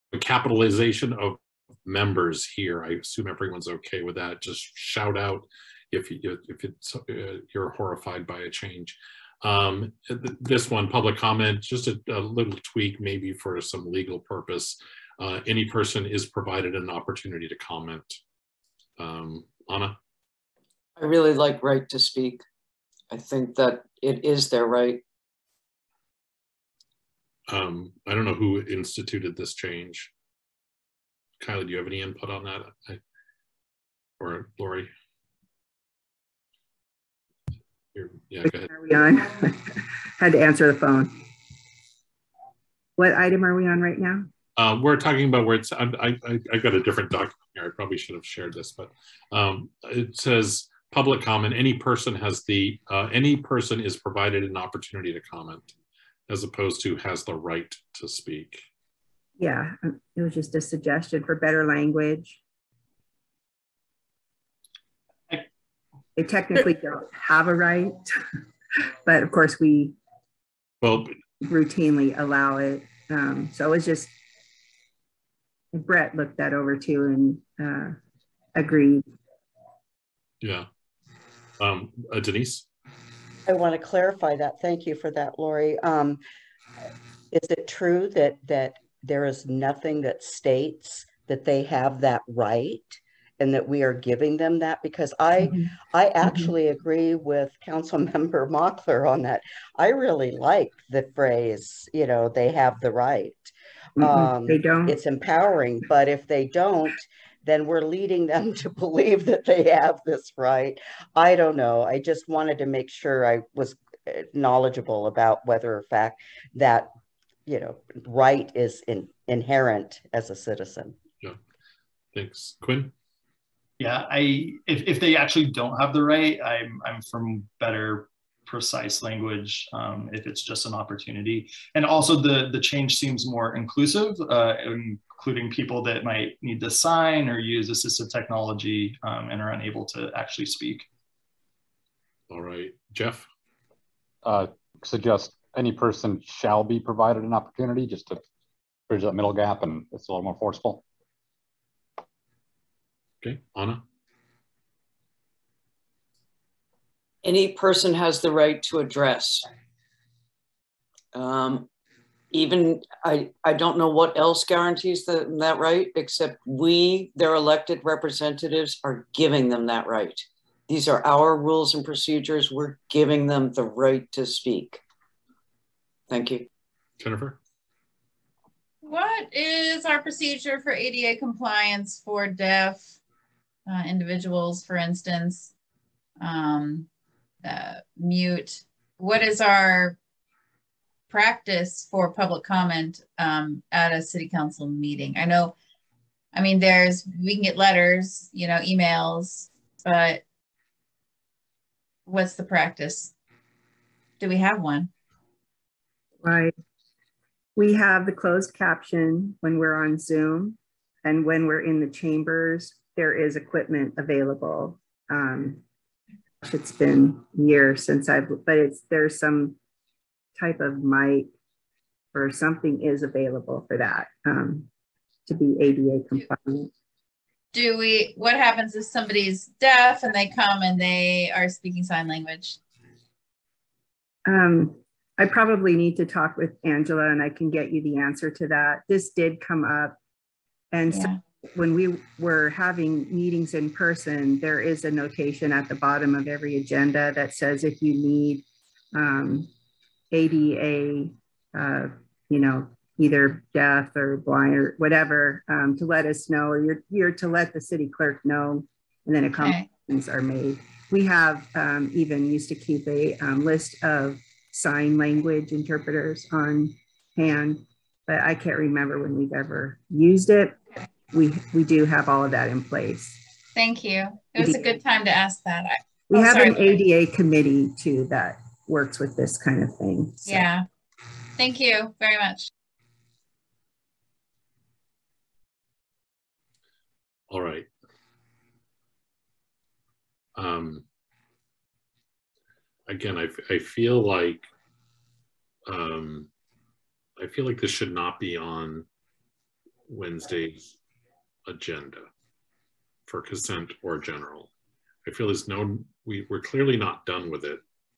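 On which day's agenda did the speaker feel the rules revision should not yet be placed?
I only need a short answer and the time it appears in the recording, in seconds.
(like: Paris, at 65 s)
Wednesday, at 299 s.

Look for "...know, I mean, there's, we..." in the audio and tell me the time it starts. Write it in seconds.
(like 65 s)
195 s.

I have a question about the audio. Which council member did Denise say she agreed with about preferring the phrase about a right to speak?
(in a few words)
Mockler.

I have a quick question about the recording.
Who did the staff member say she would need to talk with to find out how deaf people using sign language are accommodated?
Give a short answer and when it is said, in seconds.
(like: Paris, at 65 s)
Angela, at 236 s.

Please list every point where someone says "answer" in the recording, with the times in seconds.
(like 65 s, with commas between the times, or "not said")
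40 s, 237 s.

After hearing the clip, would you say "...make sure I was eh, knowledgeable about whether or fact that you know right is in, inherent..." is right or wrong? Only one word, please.
right.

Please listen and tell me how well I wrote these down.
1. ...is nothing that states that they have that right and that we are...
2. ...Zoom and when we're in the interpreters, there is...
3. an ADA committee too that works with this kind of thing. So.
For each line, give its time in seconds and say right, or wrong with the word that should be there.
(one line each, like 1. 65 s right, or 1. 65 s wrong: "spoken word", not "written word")
1. 89 s right
2. 209 s wrong: "chambers", not "interpreters"
3. 276 s right.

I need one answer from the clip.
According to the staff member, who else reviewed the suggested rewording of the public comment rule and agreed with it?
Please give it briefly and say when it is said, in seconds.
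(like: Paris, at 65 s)
Brett, at 75 s.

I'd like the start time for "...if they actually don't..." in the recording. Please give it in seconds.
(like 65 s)
124 s.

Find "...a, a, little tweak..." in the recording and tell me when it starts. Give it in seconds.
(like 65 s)
11 s.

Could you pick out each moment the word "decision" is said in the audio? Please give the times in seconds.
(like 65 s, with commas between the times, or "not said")
not said.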